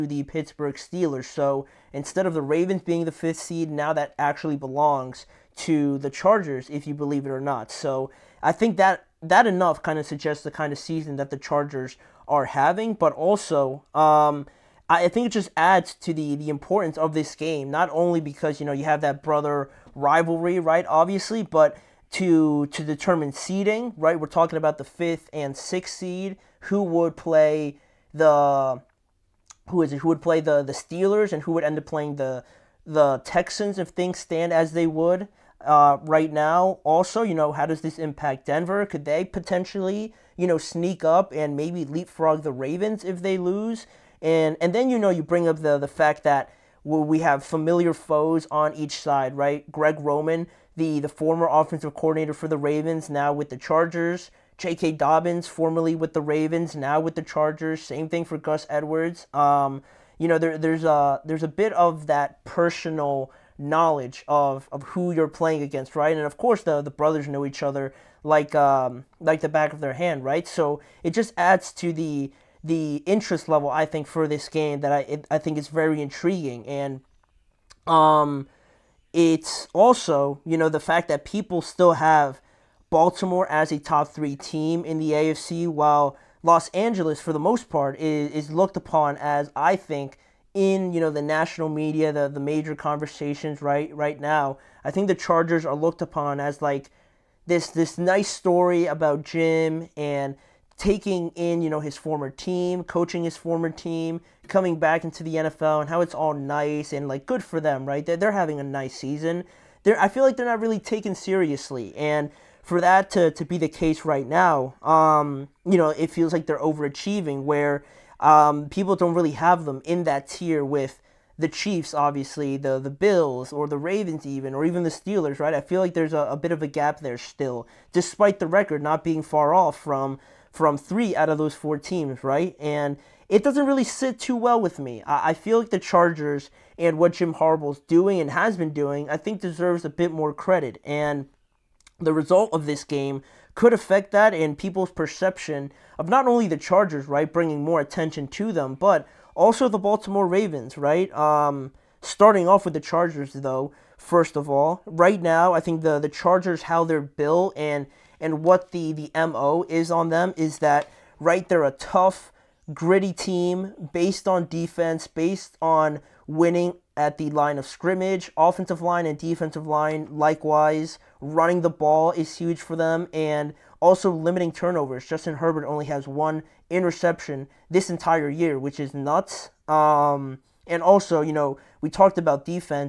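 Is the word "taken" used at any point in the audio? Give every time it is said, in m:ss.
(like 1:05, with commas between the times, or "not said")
1:50.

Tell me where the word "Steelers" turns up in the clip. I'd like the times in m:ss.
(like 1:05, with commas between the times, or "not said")
0:00, 0:30, 2:04.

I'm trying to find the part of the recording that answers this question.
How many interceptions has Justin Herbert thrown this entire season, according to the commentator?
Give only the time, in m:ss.
2:56.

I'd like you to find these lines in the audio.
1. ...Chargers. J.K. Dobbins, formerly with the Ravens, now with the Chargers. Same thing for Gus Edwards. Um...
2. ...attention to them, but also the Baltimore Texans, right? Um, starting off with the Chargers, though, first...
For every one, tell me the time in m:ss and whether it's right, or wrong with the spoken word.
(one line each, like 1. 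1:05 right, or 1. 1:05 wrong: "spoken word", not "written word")
1. 0:53 right
2. 2:27 wrong: "Ravens", not "Texans".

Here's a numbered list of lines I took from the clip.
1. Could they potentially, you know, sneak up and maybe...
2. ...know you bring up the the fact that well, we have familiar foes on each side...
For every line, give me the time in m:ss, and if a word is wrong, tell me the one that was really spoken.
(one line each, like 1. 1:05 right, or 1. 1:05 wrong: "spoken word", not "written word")
1. 0:38 right
2. 0:44 right.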